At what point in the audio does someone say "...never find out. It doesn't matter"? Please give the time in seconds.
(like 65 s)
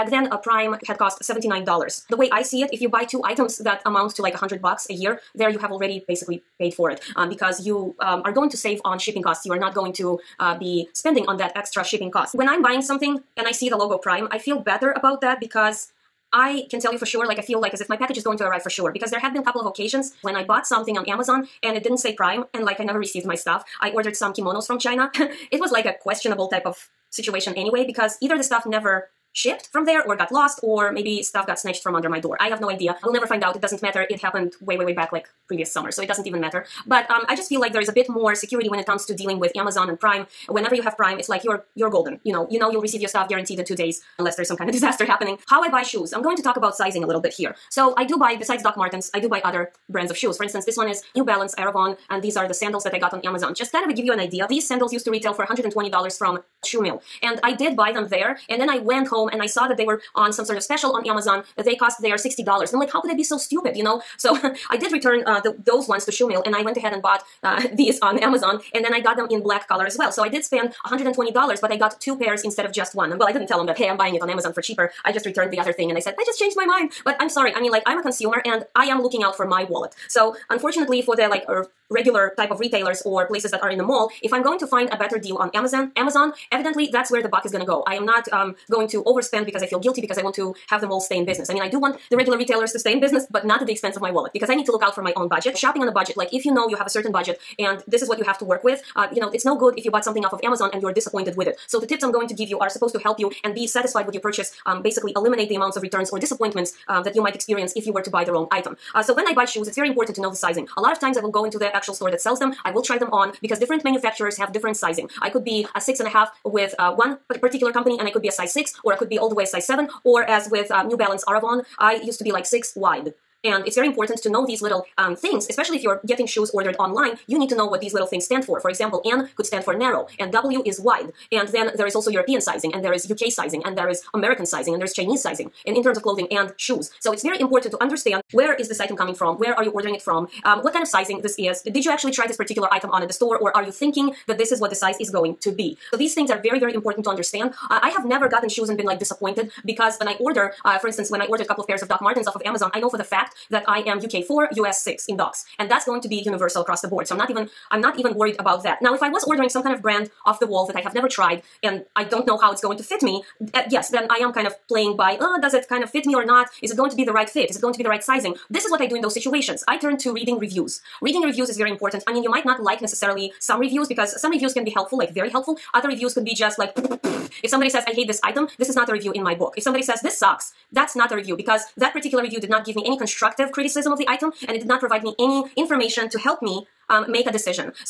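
33 s.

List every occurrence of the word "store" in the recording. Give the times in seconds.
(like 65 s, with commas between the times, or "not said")
111 s, 143 s.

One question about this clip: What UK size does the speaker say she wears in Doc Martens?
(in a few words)
UK 4.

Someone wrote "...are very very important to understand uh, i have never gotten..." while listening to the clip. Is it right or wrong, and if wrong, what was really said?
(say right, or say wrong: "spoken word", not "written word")
right.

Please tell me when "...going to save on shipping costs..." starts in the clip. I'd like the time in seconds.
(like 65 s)
8 s.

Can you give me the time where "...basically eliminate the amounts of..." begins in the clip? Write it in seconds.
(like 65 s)
104 s.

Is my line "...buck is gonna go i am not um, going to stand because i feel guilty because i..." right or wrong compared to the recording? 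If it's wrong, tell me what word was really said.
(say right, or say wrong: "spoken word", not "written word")
wrong: "overspend", not "stand".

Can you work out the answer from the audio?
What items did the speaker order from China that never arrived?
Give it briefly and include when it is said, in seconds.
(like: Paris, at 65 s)
kimonos, at 24 s.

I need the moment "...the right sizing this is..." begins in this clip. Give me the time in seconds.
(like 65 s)
167 s.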